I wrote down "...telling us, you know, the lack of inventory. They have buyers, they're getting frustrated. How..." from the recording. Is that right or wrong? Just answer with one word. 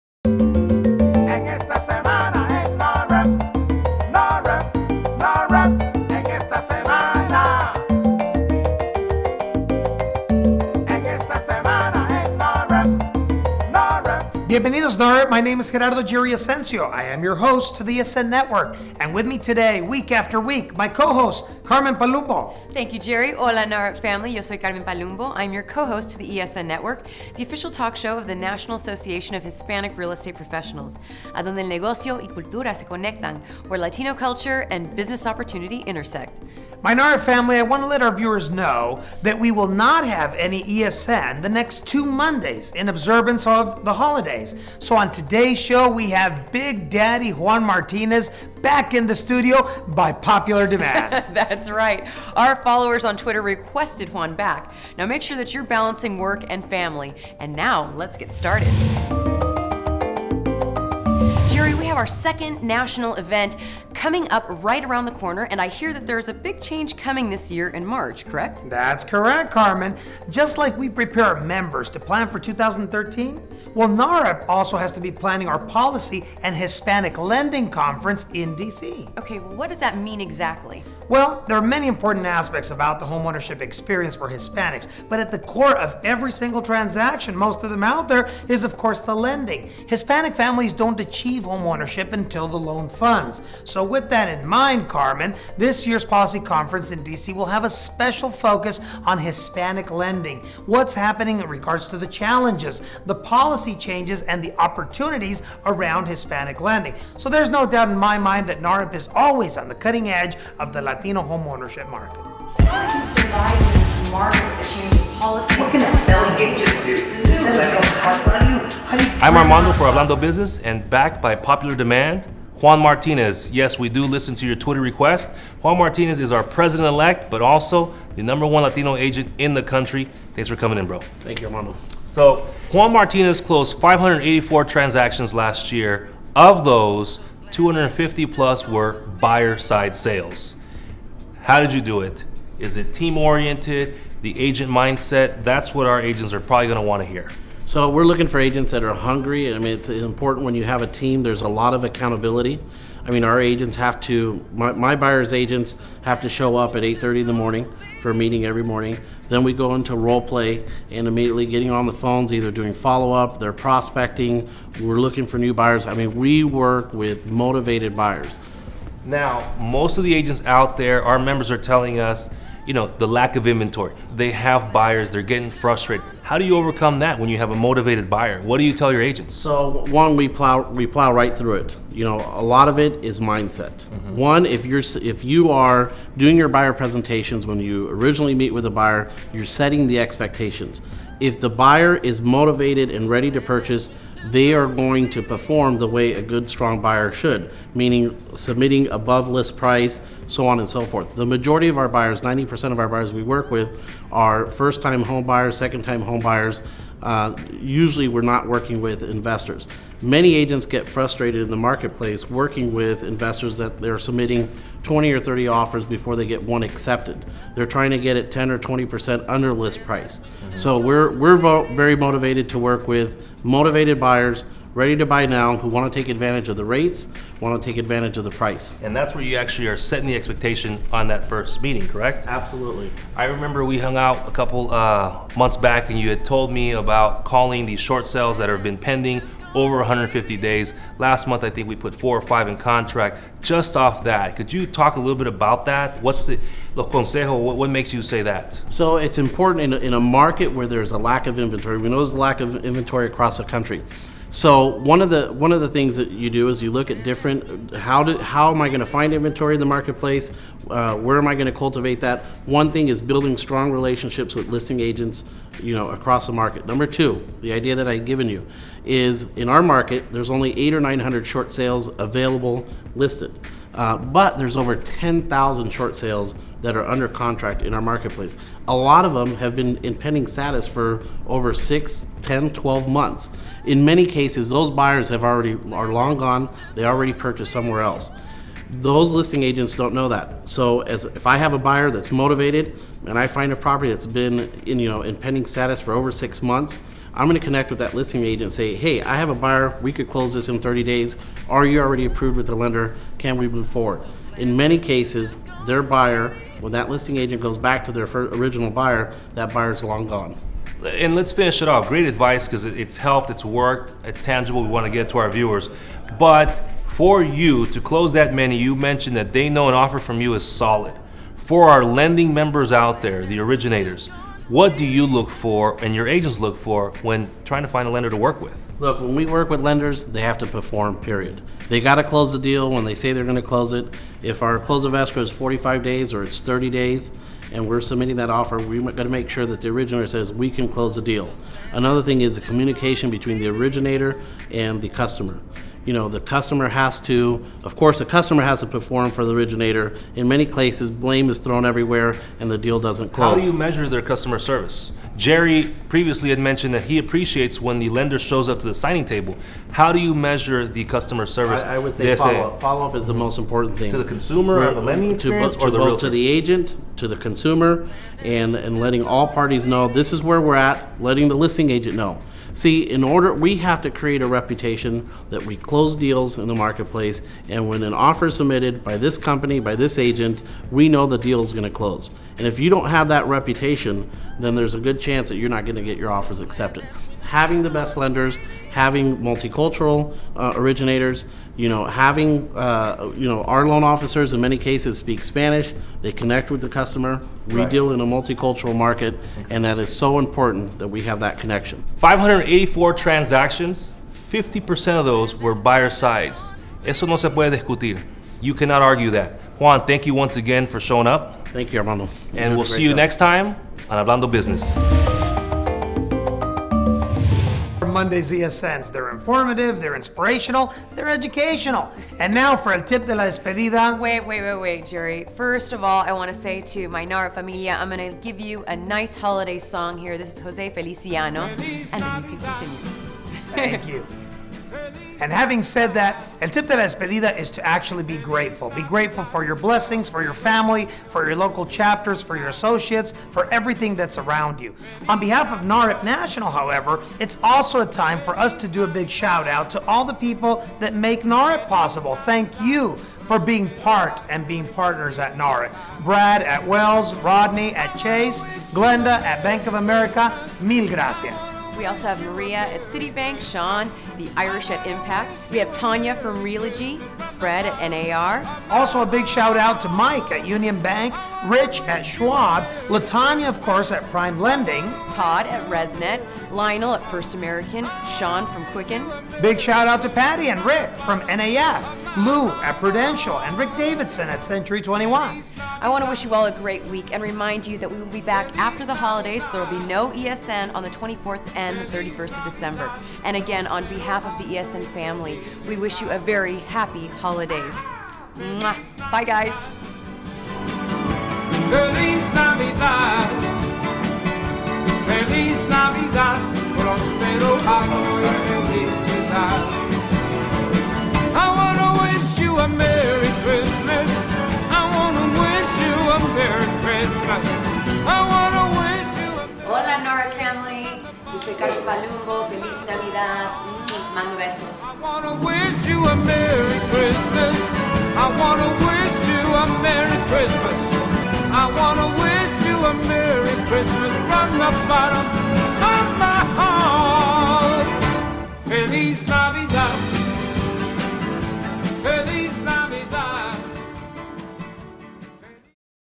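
right.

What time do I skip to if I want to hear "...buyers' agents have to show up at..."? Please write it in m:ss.
2:34.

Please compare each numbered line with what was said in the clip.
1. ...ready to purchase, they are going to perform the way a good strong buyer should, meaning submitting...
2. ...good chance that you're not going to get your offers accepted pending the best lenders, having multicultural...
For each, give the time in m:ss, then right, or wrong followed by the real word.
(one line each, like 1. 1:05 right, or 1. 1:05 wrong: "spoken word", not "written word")
1. 3:13 right
2. 6:24 wrong: "having", not "pending".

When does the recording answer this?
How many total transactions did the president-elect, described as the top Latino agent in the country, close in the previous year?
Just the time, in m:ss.
2:13.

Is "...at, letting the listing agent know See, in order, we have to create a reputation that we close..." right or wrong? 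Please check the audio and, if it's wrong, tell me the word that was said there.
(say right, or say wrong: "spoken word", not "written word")
right.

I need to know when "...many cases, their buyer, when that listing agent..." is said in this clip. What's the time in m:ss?
5:04.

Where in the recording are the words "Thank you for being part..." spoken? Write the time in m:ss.
7:32.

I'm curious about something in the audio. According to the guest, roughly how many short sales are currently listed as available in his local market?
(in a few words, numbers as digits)
eight or 900.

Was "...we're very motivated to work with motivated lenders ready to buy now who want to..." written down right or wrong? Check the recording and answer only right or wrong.
wrong.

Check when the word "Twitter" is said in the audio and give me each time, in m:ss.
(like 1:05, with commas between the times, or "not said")
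0:53, 2:04.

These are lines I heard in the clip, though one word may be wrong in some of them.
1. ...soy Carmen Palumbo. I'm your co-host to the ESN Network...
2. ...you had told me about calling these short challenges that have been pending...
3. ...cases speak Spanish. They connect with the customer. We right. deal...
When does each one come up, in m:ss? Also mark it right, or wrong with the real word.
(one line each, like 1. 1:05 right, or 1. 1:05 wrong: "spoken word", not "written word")
1. 0:24 right
2. 3:55 wrong: "sales", not "challenges"
3. 6:34 right.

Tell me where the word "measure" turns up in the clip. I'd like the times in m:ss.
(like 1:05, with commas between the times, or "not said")
5:53, 6:00.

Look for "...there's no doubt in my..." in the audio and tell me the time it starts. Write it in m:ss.
1:47.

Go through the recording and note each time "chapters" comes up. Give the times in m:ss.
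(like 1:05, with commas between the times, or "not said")
7:21.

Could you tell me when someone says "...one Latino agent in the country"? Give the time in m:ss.
2:08.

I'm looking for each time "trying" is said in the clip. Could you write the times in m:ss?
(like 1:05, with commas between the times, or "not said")
3:37, 5:27.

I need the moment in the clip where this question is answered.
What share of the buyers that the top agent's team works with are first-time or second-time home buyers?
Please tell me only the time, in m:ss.
3:22.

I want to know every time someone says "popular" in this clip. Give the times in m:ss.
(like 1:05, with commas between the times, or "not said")
0:50, 2:01.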